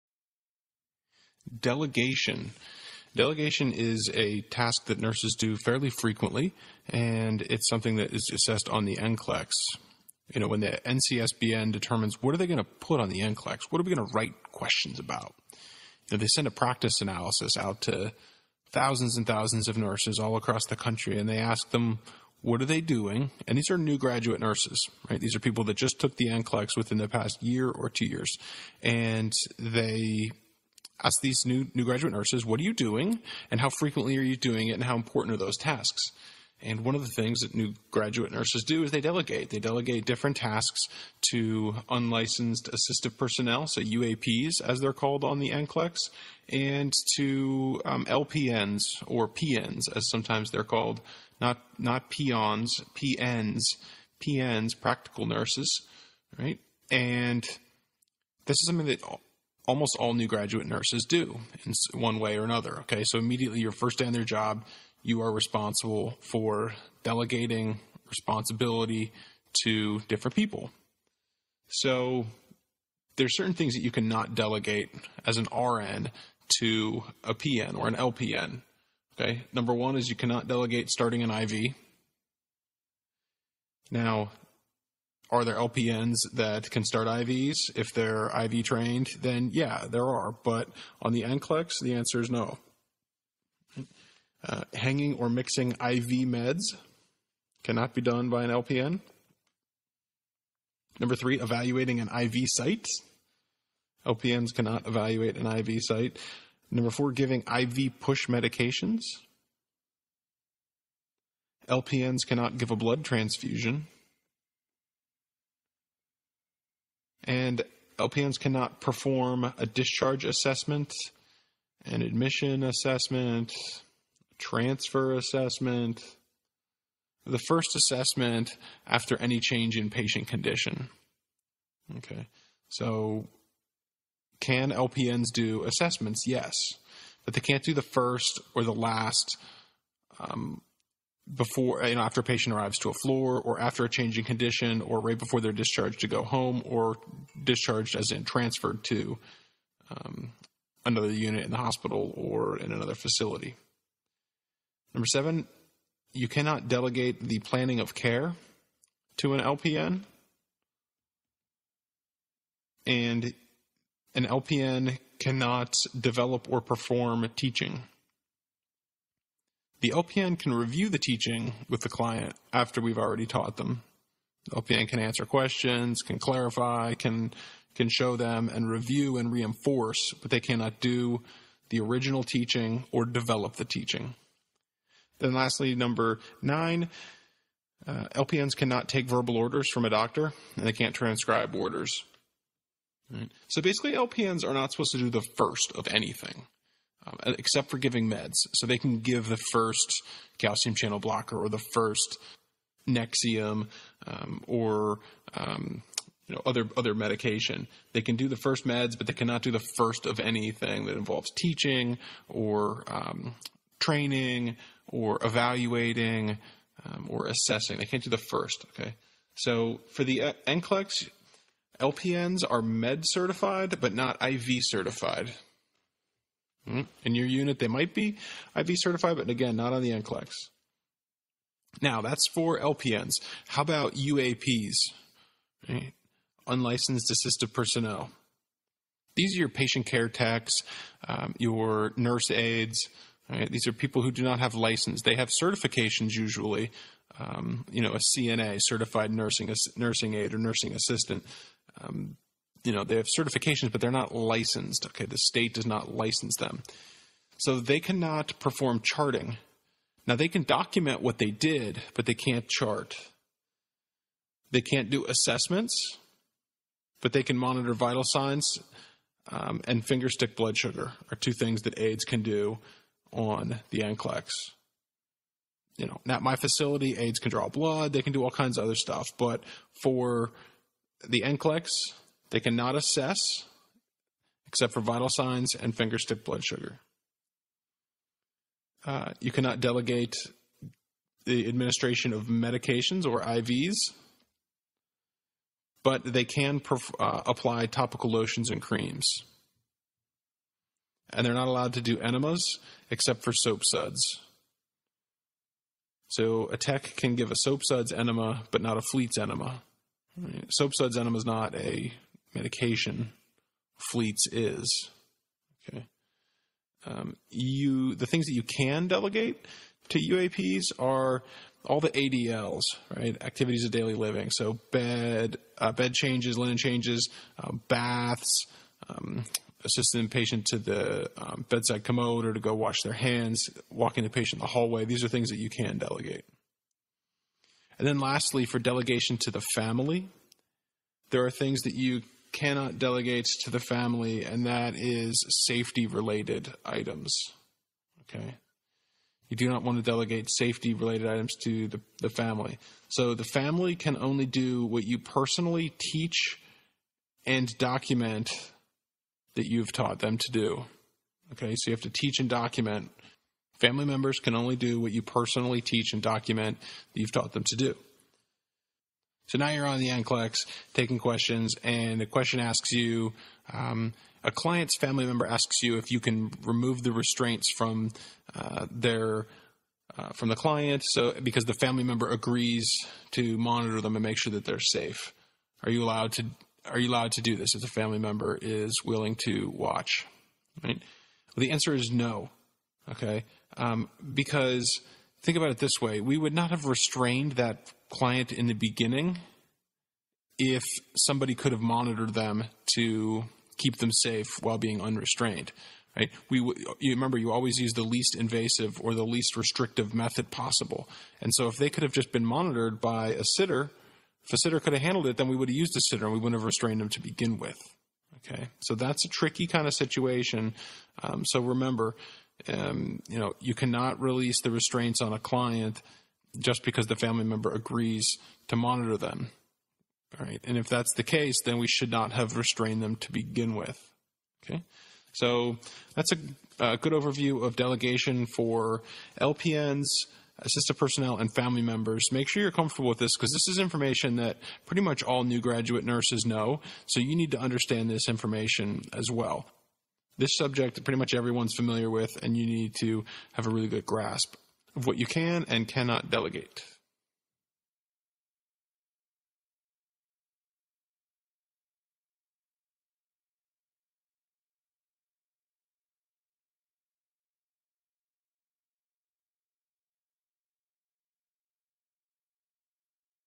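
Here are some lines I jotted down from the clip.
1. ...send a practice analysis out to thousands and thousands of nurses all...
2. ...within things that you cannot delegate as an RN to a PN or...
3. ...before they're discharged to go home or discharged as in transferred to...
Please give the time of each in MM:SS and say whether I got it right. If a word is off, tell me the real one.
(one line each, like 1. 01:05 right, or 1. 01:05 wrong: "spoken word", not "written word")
1. 00:16 right
2. 01:13 wrong: "certain", not "within"
3. 02:25 right.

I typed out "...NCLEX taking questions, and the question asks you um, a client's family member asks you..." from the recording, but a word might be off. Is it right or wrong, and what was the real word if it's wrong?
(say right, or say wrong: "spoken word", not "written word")
right.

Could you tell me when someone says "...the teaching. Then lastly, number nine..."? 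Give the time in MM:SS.
03:03.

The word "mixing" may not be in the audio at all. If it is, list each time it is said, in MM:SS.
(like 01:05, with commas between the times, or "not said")
01:35.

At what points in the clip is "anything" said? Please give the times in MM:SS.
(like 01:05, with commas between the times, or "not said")
03:15, 03:30.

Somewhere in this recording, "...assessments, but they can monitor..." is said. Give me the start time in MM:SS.
04:25.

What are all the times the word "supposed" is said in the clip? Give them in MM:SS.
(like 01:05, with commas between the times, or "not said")
03:14.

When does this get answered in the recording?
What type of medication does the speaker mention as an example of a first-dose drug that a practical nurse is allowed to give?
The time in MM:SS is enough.
03:20.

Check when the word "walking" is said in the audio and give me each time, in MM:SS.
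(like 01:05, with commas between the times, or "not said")
05:33.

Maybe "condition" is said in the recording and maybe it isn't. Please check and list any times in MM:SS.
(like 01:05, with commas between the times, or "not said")
02:10, 02:24.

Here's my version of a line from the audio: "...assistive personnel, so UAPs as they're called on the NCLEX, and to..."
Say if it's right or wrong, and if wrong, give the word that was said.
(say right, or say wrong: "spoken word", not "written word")
right.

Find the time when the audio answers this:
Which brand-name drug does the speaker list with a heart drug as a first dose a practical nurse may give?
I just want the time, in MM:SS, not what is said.
03:22.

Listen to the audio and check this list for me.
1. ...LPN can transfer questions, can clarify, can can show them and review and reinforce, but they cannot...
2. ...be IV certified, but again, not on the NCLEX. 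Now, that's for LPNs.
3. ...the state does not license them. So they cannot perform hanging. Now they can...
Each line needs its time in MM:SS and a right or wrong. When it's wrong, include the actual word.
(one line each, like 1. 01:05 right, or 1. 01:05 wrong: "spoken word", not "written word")
1. 02:54 wrong: "answer", not "transfer"
2. 03:47 right
3. 04:15 wrong: "charting", not "hanging".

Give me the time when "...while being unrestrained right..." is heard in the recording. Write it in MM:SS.
06:44.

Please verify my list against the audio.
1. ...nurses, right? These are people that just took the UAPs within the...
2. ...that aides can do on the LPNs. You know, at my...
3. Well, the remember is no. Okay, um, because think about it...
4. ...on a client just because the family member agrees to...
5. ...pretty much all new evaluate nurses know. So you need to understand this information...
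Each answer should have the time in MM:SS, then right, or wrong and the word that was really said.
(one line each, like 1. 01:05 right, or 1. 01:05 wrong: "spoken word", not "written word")
1. 00:24 wrong: "NCLEX", not "UAPs"
2. 04:31 wrong: "NCLEX", not "LPNs"
3. 06:31 wrong: "answer", not "remember"
4. 07:05 right
5. 07:24 wrong: "graduate", not "evaluate".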